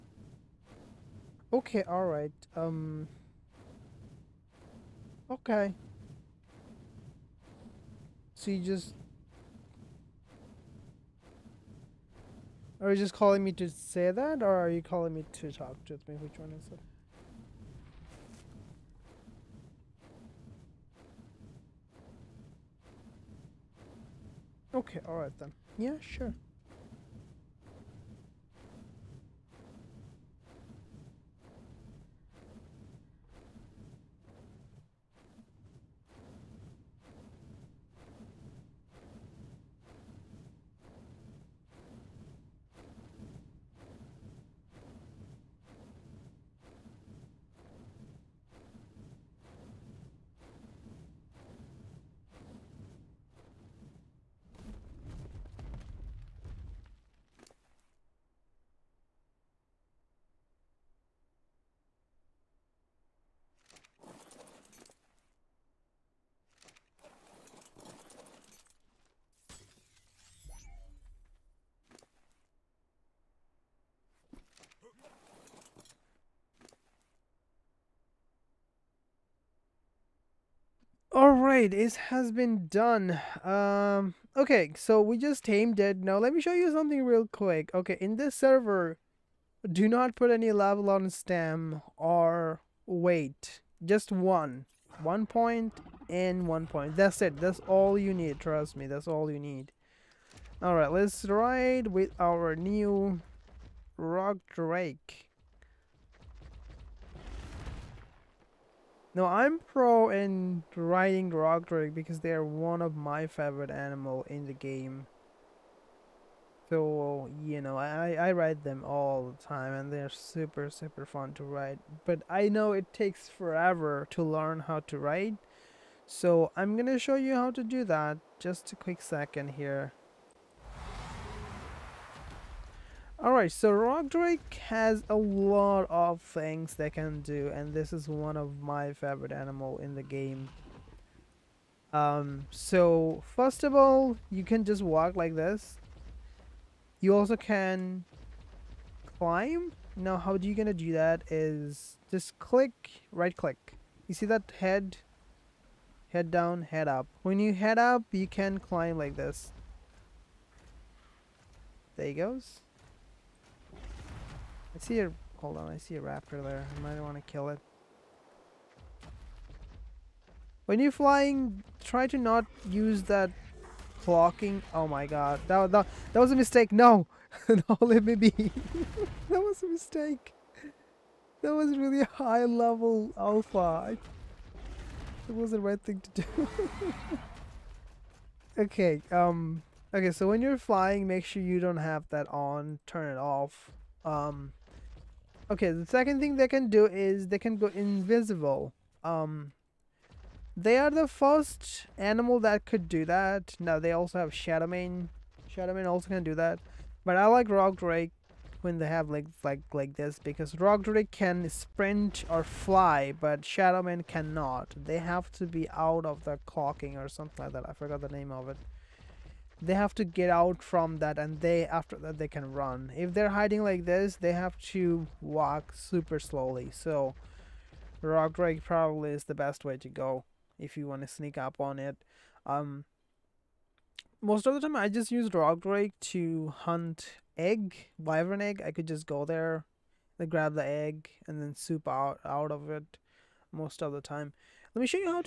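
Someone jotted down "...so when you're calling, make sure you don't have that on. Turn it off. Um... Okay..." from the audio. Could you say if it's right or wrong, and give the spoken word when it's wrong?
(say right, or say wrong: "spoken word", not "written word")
wrong: "flying", not "calling".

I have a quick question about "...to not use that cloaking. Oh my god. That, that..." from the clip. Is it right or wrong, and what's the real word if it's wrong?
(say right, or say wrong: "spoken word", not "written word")
right.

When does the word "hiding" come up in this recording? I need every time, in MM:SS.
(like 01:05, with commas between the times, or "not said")
03:43.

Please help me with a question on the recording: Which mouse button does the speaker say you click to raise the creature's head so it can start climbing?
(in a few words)
Right click.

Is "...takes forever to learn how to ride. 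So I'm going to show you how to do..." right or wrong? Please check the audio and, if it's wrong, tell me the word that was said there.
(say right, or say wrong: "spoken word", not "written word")
right.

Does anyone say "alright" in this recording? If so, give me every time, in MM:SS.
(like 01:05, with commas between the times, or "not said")
00:01, 00:25, 01:40, 02:13.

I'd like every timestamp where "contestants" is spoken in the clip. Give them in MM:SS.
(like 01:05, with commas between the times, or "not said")
not said.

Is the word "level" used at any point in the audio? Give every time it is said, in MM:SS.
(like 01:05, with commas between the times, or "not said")
01:30, 03:02.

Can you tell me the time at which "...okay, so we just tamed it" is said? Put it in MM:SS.
01:24.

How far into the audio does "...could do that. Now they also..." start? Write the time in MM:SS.
03:22.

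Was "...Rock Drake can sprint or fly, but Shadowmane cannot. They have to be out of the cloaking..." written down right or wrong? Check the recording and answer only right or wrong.
right.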